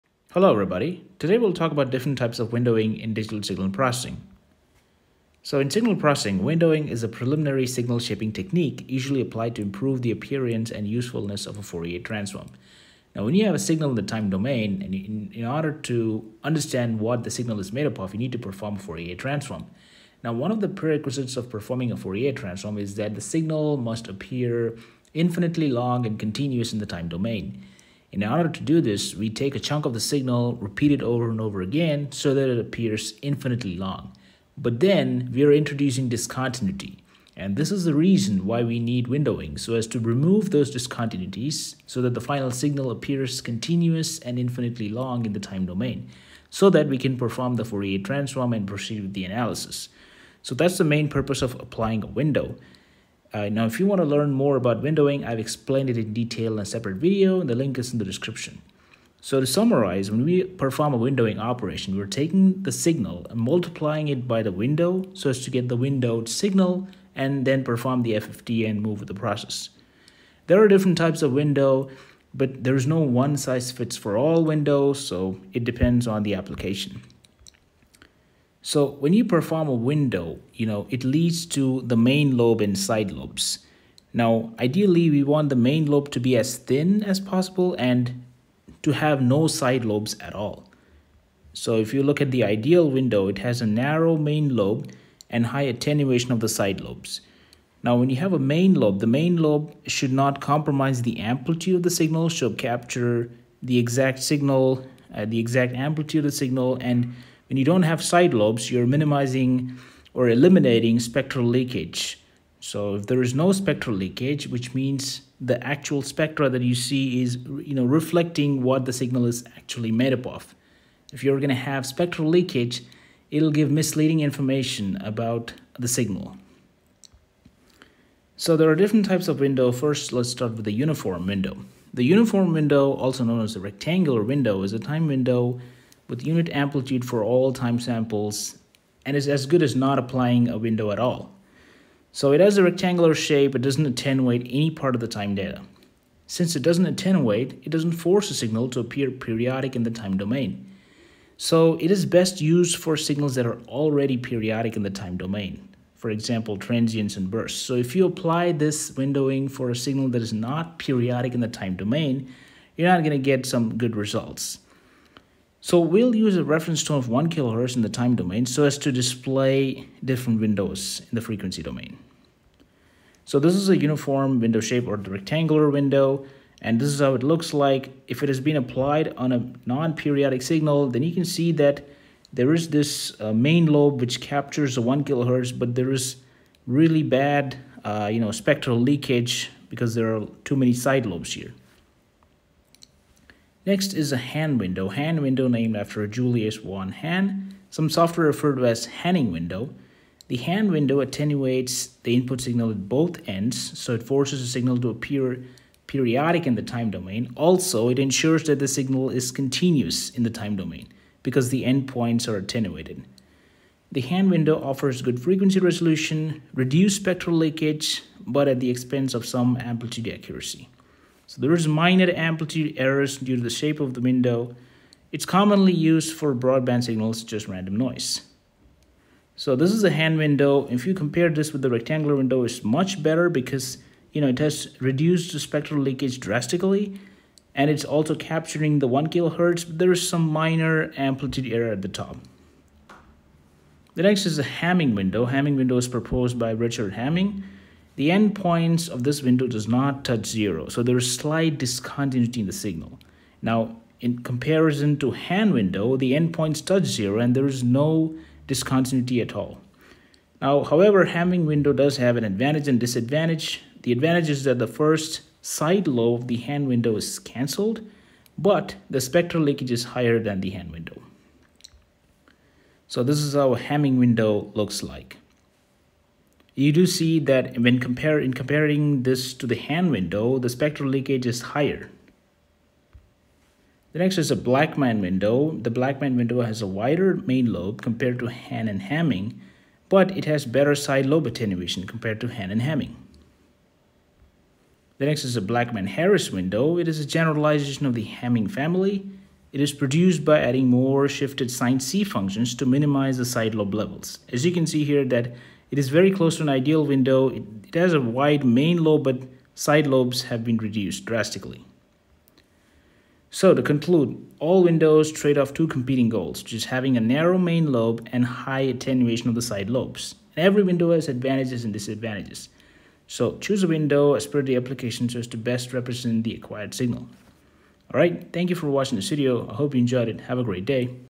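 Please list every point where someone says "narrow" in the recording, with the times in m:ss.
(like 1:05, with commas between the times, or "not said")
1:33, 5:17.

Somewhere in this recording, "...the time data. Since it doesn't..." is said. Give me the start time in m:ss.
2:25.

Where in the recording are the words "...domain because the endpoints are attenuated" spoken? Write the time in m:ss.
3:30.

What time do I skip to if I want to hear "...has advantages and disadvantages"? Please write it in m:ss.
5:20.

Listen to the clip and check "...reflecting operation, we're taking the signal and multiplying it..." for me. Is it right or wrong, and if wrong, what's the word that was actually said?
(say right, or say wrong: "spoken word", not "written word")
wrong: "windowing", not "reflecting".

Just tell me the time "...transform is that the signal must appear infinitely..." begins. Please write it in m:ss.
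0:22.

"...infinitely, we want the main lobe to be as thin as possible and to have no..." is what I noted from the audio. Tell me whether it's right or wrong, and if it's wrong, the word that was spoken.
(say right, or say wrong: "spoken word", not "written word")
wrong: "ideally", not "infinitely".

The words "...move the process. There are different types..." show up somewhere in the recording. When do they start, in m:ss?
1:08.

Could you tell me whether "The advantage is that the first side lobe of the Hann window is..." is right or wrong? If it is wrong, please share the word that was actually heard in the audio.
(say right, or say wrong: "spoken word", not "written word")
right.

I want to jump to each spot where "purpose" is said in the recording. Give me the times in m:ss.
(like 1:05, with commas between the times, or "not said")
0:51.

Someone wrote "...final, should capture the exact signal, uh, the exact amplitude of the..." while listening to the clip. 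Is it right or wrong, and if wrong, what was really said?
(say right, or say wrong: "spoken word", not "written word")
wrong: "signal", not "final".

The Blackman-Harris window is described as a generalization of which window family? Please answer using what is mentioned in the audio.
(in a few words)
Hamming family.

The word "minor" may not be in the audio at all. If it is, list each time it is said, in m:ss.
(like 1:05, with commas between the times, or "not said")
3:41, 4:00.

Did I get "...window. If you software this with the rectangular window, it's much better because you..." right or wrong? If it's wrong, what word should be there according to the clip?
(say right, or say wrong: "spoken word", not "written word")
wrong: "compare", not "software".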